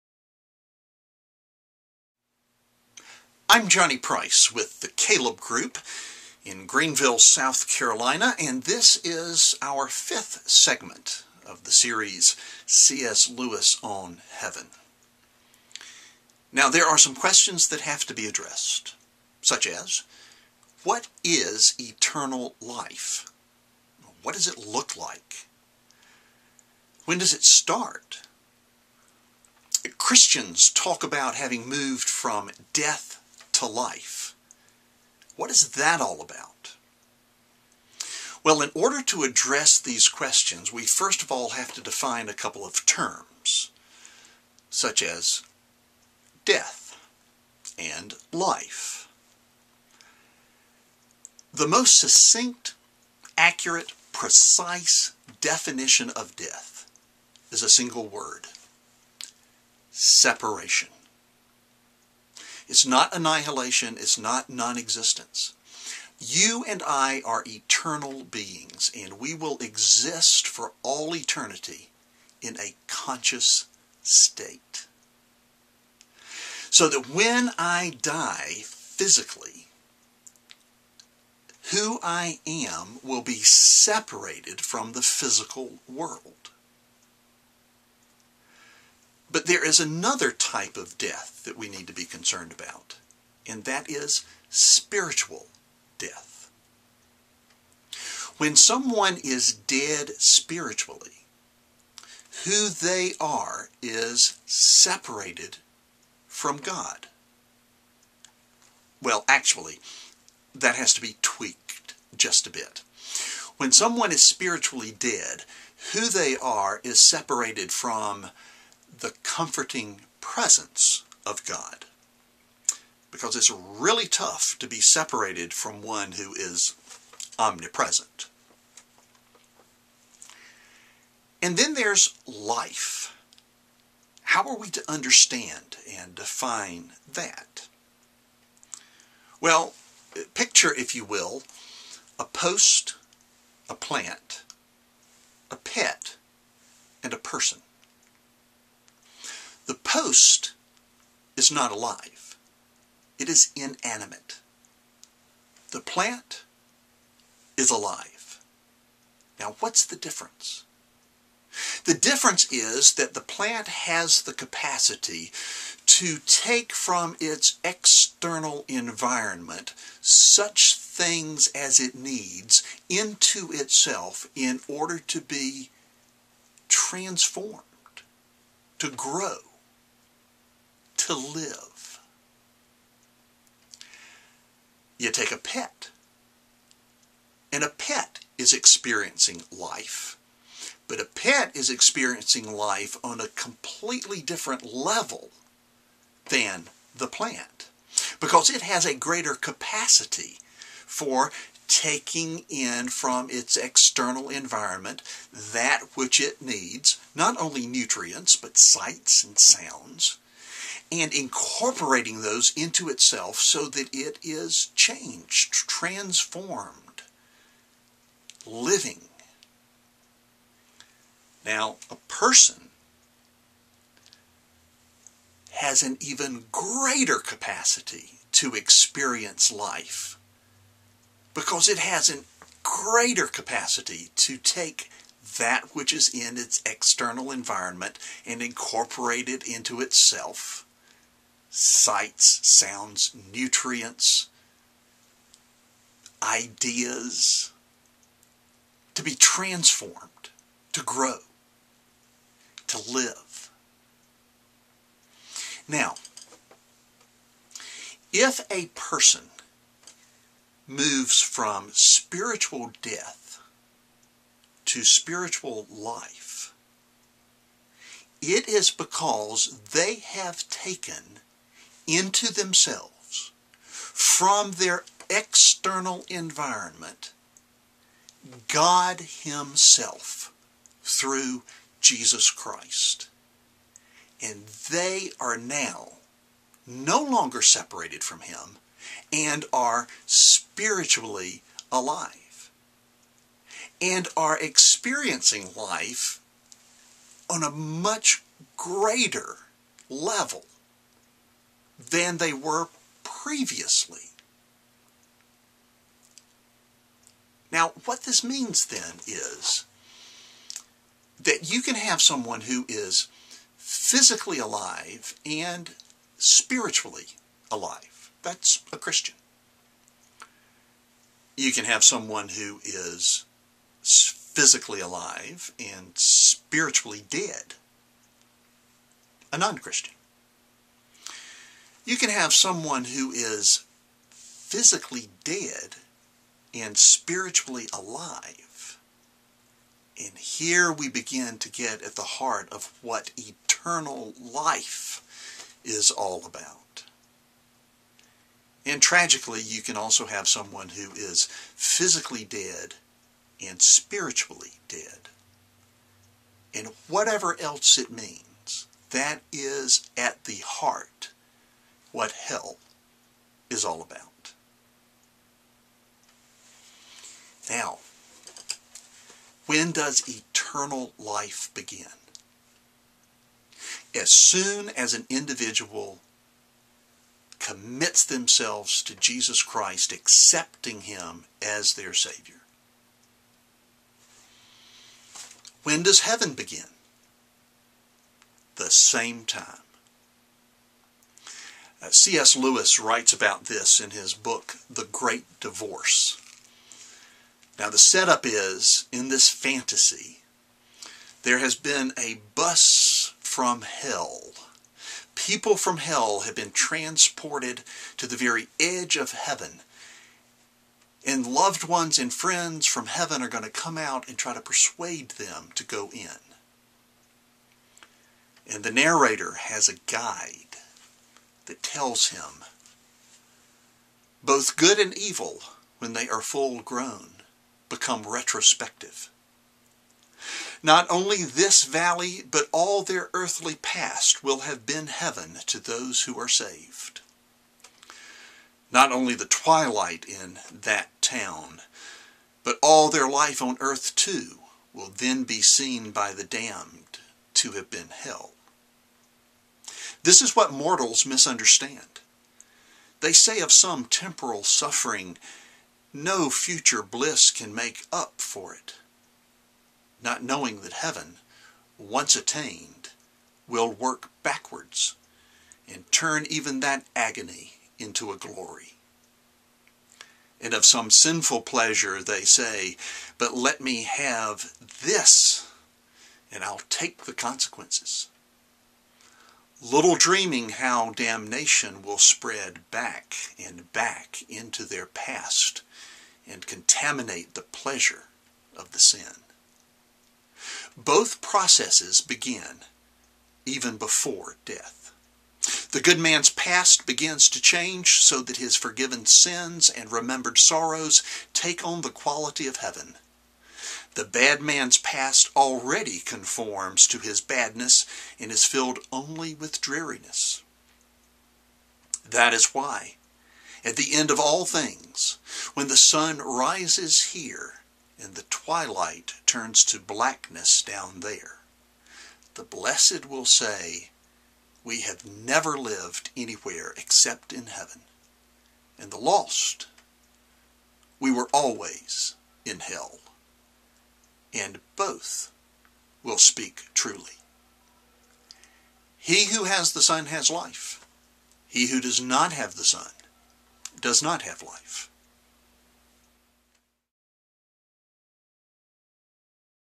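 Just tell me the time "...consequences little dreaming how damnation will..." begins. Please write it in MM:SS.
07:57.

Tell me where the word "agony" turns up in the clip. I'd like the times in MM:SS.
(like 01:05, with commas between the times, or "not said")
07:46.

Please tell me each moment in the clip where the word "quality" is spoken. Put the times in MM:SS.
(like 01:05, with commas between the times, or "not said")
08:21.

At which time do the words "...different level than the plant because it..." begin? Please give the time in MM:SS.
03:14.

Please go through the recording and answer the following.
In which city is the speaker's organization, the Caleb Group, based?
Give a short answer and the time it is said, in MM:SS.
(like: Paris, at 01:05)
Greenville, South Carolina, at 00:06.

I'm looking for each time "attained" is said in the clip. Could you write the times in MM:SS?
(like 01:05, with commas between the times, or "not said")
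07:42.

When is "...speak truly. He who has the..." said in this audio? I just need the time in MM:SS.
08:56.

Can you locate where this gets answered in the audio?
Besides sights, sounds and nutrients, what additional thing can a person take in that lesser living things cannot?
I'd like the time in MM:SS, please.
04:06.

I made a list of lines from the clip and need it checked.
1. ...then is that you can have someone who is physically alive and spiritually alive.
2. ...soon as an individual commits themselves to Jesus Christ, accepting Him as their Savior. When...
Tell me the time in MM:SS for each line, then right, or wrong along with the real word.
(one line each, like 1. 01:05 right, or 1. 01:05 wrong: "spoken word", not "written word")
1. 05:08 right
2. 06:14 right.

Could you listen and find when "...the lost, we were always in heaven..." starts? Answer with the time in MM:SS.
08:48.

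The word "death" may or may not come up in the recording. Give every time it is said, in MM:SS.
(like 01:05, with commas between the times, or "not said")
00:32, 00:46, 00:56, 01:30, 01:35, 04:22, 08:14.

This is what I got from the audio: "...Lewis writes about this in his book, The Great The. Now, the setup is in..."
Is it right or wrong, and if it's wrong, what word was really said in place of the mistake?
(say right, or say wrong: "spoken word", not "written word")
wrong: "Divorce", not "The".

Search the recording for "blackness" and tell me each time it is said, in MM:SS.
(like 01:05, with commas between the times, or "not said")
08:39.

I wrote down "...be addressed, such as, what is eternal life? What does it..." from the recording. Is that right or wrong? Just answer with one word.
right.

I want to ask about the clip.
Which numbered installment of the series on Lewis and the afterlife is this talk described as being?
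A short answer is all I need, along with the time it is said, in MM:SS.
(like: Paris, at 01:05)
Fifth, at 00:09.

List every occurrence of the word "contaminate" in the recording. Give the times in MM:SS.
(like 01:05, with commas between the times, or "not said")
08:06.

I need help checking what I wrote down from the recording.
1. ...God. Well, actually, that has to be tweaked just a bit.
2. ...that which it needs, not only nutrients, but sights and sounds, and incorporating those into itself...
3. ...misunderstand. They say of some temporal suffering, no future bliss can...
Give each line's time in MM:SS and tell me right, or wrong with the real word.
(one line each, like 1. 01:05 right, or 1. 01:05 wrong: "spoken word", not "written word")
1. 01:46 right
2. 03:25 right
3. 07:31 right.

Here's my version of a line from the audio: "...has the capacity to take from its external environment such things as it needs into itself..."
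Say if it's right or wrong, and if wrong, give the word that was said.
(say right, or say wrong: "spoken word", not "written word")
right.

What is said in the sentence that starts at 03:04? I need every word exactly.
You take a pet, and a pet is experiencing life.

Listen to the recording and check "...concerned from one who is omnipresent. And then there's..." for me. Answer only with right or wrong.
wrong.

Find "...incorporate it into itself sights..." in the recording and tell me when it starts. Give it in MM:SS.
03:58.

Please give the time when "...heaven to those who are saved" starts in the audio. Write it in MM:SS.
07:14.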